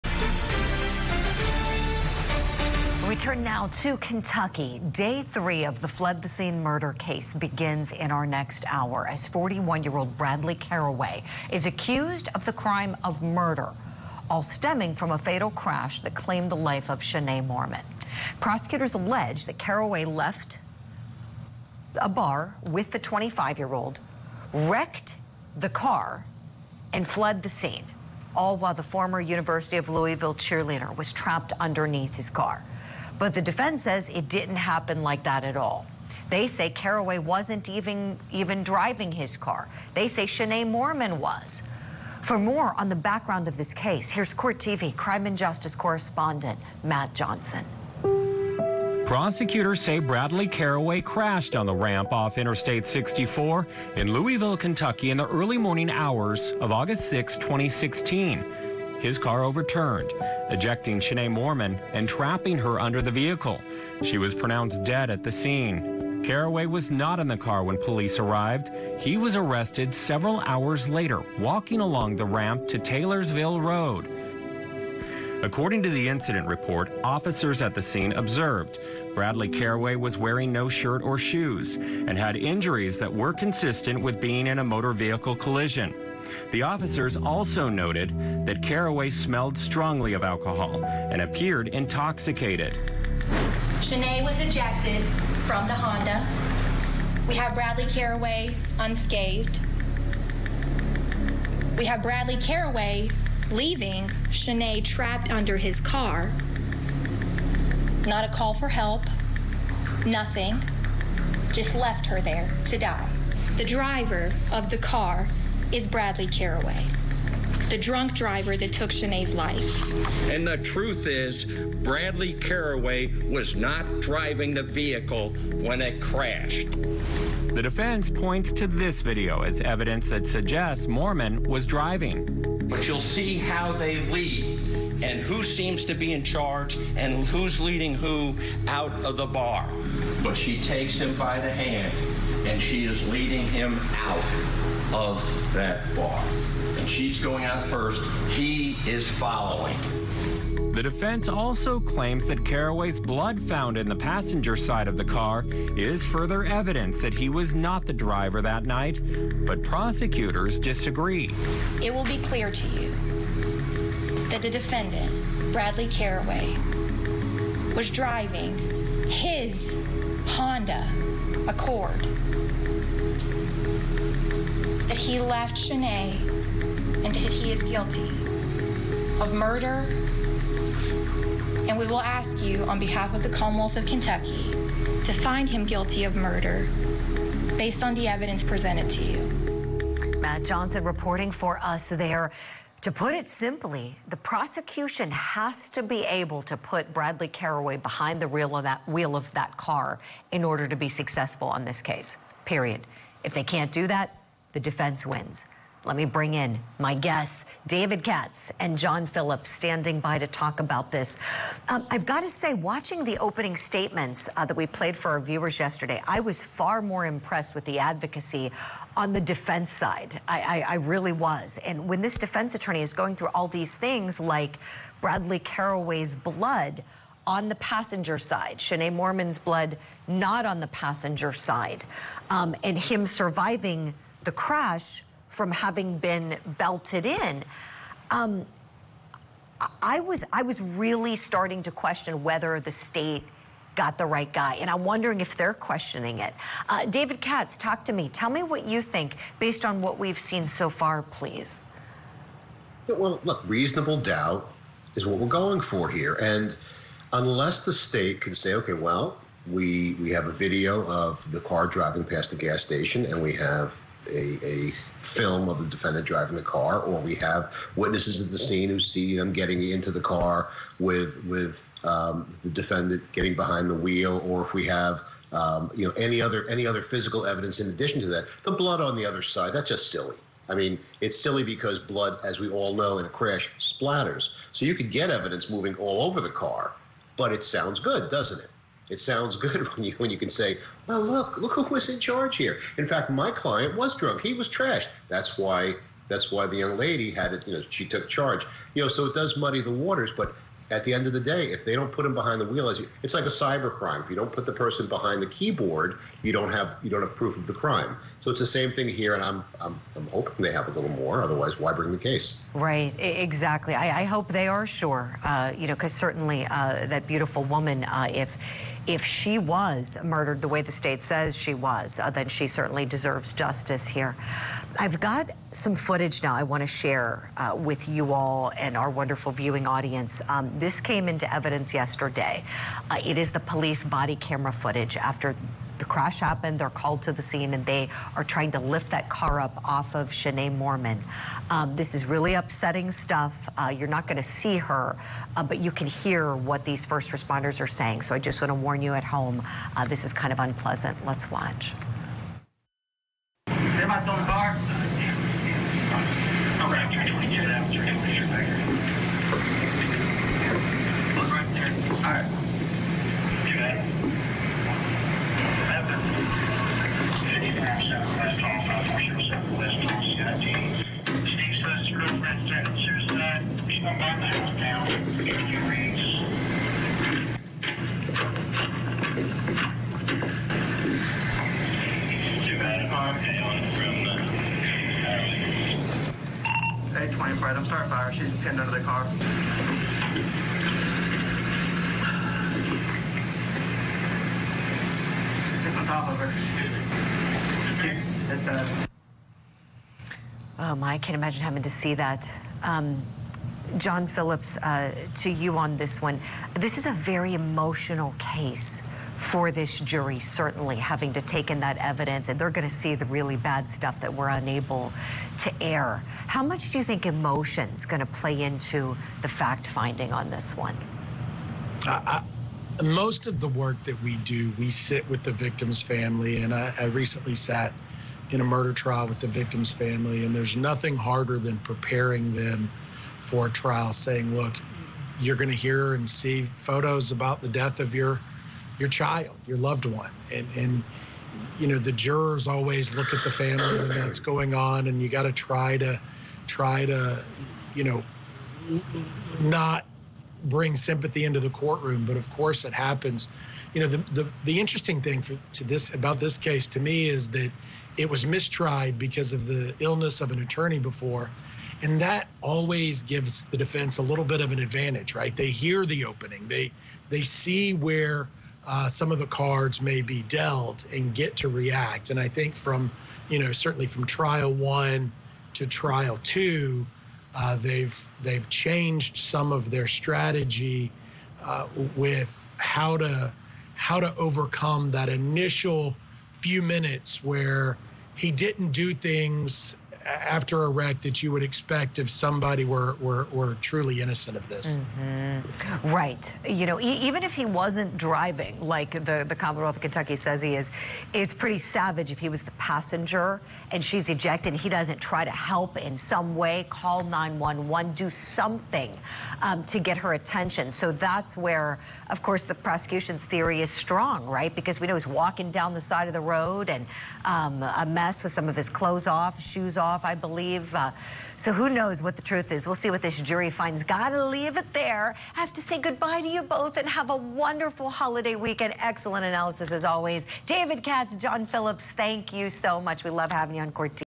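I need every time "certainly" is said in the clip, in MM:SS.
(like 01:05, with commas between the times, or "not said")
05:15, 05:22, 06:50, 07:53.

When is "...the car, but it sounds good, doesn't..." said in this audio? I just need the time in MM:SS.
04:46.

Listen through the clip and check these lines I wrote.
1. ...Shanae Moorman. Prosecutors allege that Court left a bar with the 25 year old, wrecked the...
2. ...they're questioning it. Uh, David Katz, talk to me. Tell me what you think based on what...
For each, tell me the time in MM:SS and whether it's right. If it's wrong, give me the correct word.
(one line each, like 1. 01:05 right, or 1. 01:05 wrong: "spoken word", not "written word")
1. 00:17 wrong: "Caraway", not "Court"
2. 04:05 right.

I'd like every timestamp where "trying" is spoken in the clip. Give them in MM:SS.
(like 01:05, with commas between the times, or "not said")
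05:38.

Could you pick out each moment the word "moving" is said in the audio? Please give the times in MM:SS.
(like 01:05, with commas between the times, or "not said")
04:45.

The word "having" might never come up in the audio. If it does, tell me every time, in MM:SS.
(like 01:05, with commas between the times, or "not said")
03:55, 06:41, 06:50, 08:53.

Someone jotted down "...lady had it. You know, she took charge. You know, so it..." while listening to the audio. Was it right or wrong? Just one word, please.
right.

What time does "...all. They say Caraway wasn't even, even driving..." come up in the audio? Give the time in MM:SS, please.
00:35.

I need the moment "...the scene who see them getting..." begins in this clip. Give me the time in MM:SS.
04:28.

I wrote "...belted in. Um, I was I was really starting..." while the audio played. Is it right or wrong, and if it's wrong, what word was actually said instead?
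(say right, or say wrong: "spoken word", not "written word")
right.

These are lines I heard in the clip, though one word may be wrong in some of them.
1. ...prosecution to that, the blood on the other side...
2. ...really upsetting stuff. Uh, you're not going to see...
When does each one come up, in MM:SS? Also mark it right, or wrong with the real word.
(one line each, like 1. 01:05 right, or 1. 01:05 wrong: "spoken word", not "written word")
1. 04:37 wrong: "addition", not "prosecution"
2. 05:42 right.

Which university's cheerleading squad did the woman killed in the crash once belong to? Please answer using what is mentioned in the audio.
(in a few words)
University of Louisville.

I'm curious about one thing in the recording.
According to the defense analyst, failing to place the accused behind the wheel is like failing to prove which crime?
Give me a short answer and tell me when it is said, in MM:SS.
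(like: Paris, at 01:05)
cyber crime, at 05:03.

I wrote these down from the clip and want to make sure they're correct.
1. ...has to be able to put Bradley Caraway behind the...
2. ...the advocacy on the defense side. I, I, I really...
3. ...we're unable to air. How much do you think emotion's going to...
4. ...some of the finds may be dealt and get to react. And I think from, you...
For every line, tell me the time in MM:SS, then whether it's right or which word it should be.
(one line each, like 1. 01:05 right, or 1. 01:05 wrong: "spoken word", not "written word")
1. 03:15 right
2. 03:37 right
3. 06:54 right
4. 07:48 wrong: "cards", not "finds".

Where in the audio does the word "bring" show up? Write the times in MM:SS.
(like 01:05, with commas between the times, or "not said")
03:26, 05:11, 07:30.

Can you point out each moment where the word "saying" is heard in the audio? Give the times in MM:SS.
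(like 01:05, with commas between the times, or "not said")
05:47, 07:13.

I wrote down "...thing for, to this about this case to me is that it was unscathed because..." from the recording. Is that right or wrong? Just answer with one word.
wrong.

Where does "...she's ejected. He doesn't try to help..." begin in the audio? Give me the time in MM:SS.
08:23.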